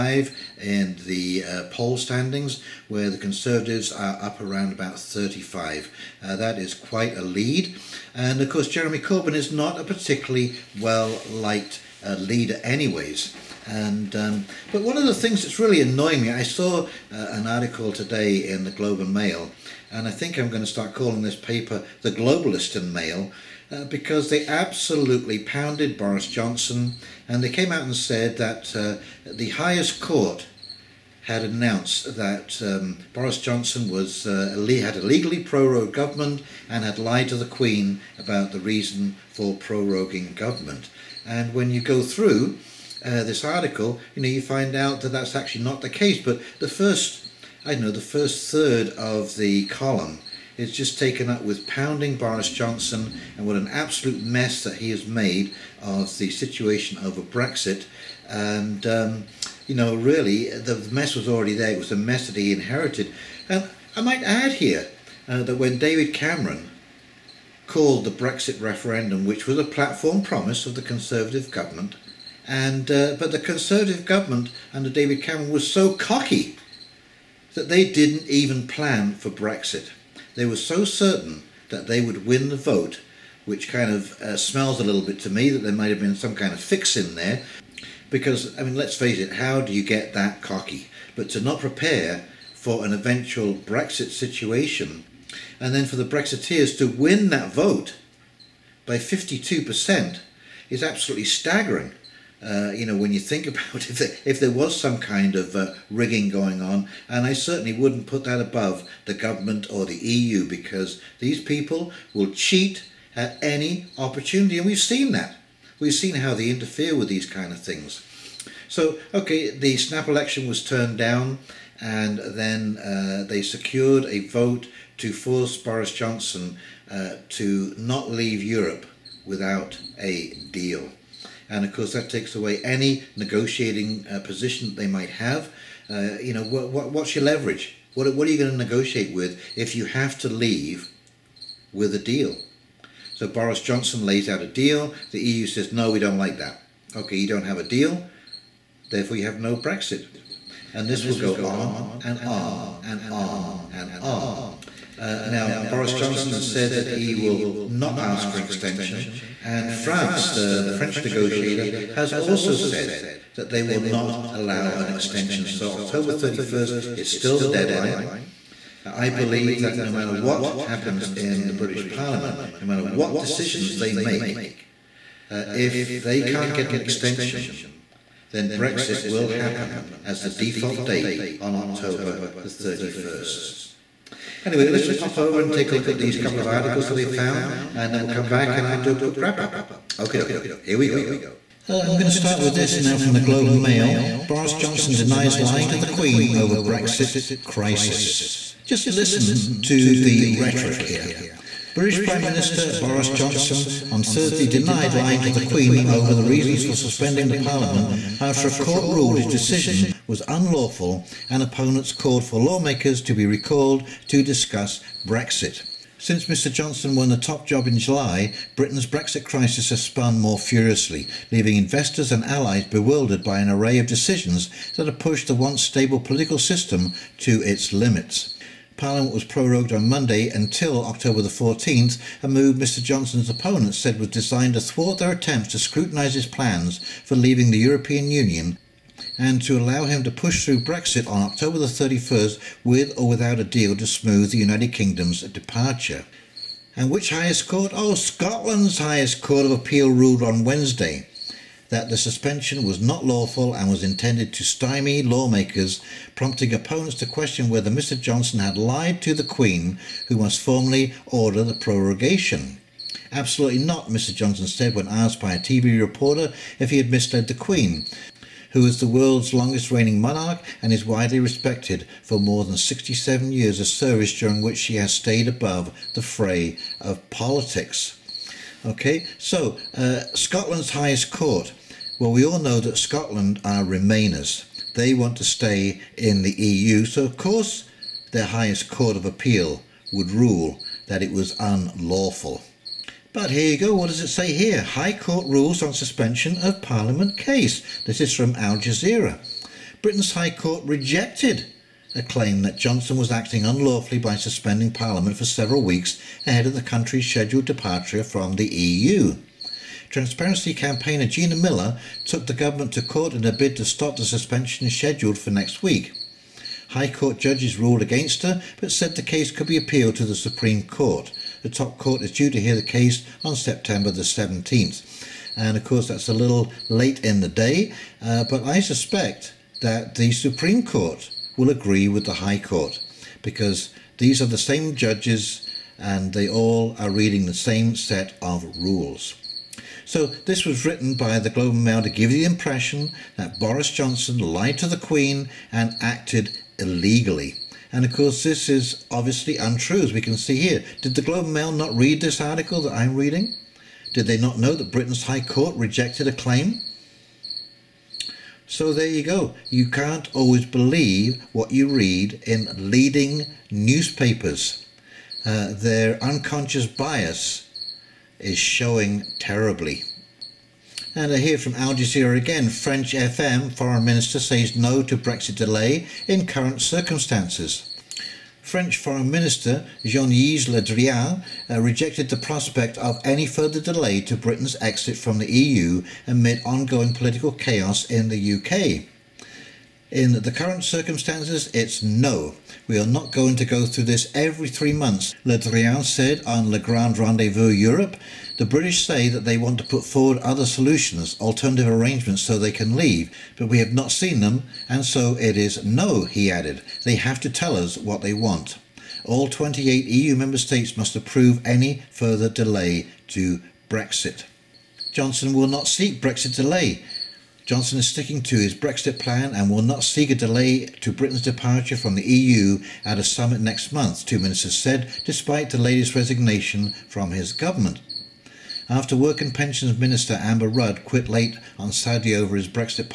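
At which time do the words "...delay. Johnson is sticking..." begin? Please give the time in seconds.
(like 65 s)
416 s.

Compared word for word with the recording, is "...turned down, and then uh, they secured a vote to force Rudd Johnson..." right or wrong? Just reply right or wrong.
wrong.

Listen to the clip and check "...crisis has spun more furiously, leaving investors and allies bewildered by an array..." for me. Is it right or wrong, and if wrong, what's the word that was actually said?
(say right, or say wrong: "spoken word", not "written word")
right.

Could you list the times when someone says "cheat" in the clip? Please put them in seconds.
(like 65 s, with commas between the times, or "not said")
112 s.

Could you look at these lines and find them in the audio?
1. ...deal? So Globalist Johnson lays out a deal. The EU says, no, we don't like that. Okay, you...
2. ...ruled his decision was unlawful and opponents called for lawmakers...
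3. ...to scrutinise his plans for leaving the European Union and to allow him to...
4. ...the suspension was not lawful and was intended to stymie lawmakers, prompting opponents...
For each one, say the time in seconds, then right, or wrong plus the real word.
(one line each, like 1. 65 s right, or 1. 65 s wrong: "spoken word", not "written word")
1. 141 s wrong: "Boris", not "Globalist"
2. 208 s right
3. 235 s right
4. 251 s right.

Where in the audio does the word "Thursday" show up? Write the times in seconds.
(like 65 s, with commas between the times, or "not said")
204 s.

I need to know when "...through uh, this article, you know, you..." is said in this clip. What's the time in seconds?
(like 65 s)
42 s.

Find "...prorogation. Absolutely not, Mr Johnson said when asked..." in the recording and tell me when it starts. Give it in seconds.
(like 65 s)
261 s.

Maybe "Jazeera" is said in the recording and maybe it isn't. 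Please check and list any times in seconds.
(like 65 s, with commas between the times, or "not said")
298 s, 371 s.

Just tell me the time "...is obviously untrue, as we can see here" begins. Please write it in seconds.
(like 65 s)
348 s.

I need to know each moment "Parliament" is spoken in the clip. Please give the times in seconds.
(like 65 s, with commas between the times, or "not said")
171 s, 207 s, 228 s, 296 s, 304 s.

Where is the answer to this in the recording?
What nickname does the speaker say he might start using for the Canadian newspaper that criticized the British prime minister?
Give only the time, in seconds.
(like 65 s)
22 s.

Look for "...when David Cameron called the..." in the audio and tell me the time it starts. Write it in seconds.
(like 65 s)
65 s.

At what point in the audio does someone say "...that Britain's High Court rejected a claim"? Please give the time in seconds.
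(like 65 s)
354 s.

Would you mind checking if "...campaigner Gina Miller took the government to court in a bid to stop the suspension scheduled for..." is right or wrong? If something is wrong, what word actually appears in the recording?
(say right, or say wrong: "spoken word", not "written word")
right.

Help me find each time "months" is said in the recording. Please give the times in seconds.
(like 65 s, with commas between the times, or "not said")
394 s, 423 s.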